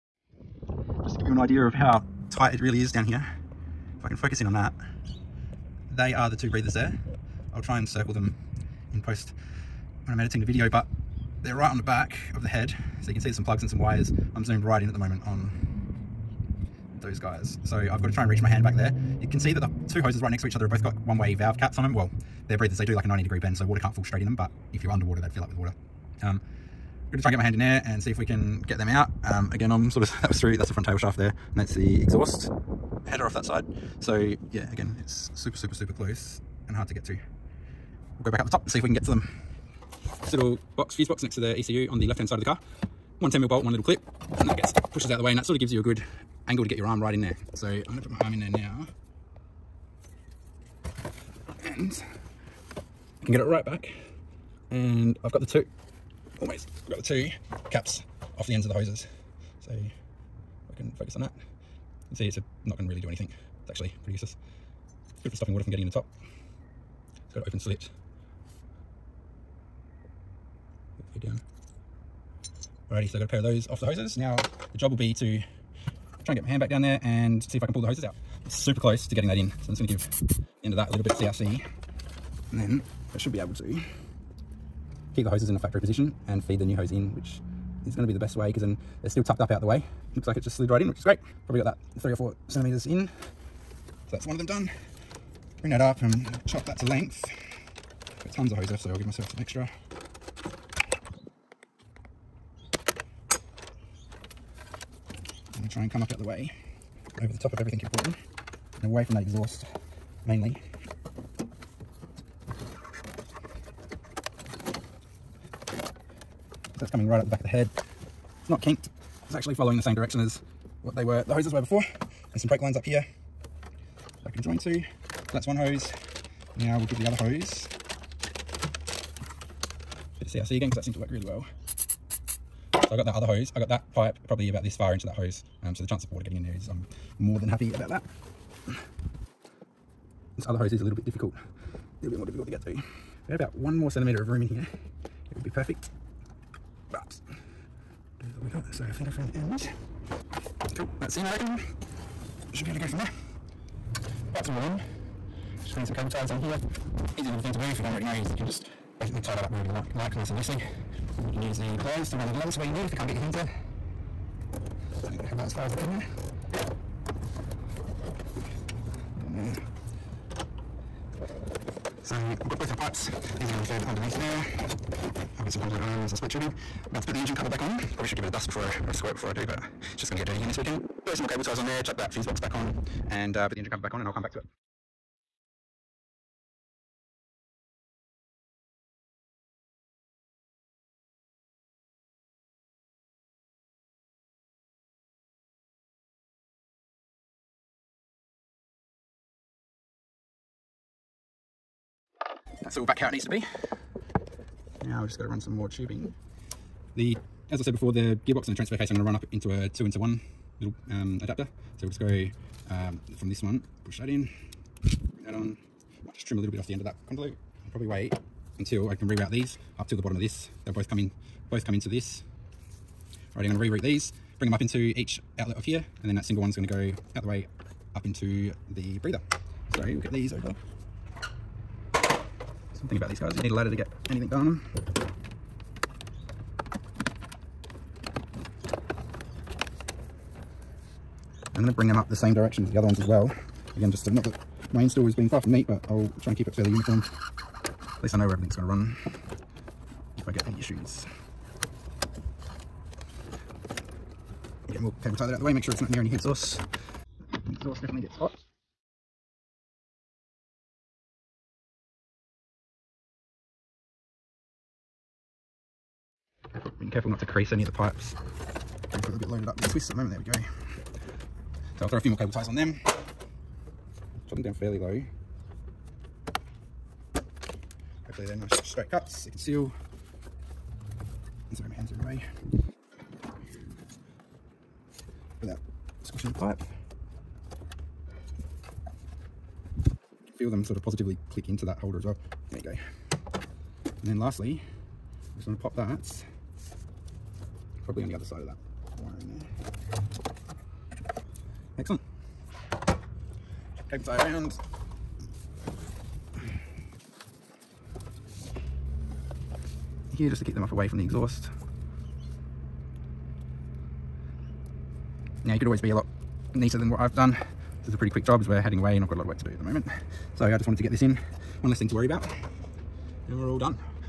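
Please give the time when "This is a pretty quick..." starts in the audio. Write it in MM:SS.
05:17.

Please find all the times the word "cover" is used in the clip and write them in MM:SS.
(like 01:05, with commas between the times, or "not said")
02:57, 03:03.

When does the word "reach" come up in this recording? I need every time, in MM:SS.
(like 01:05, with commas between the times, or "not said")
00:18.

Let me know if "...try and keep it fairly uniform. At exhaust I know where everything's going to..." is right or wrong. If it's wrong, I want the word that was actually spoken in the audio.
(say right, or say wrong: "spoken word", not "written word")
wrong: "least", not "exhaust".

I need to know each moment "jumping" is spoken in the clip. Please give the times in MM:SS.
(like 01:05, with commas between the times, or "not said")
not said.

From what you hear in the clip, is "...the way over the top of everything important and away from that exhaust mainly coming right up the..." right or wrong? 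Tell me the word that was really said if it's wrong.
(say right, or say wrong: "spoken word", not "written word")
right.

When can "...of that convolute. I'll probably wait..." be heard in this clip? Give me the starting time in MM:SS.
03:36.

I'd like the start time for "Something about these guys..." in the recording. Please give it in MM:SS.
03:52.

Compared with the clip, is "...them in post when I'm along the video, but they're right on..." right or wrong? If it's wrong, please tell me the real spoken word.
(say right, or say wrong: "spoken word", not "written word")
wrong: "editing", not "along".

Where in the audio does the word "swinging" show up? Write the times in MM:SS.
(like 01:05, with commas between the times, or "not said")
not said.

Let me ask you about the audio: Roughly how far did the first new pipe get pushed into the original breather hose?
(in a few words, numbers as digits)
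3 or 4 centimeters.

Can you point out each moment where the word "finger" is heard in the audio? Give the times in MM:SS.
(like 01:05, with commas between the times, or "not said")
not said.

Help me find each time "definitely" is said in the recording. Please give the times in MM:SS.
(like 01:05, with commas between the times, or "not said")
04:17.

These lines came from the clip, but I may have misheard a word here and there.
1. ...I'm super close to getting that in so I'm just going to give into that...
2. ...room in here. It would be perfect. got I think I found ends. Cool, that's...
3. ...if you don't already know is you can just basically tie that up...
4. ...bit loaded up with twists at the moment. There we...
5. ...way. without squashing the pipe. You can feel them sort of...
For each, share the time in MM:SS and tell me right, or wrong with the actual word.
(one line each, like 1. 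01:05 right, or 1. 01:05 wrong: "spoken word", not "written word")
1. 01:18 right
2. 02:24 right
3. 02:37 right
4. 04:29 right
5. 04:42 right.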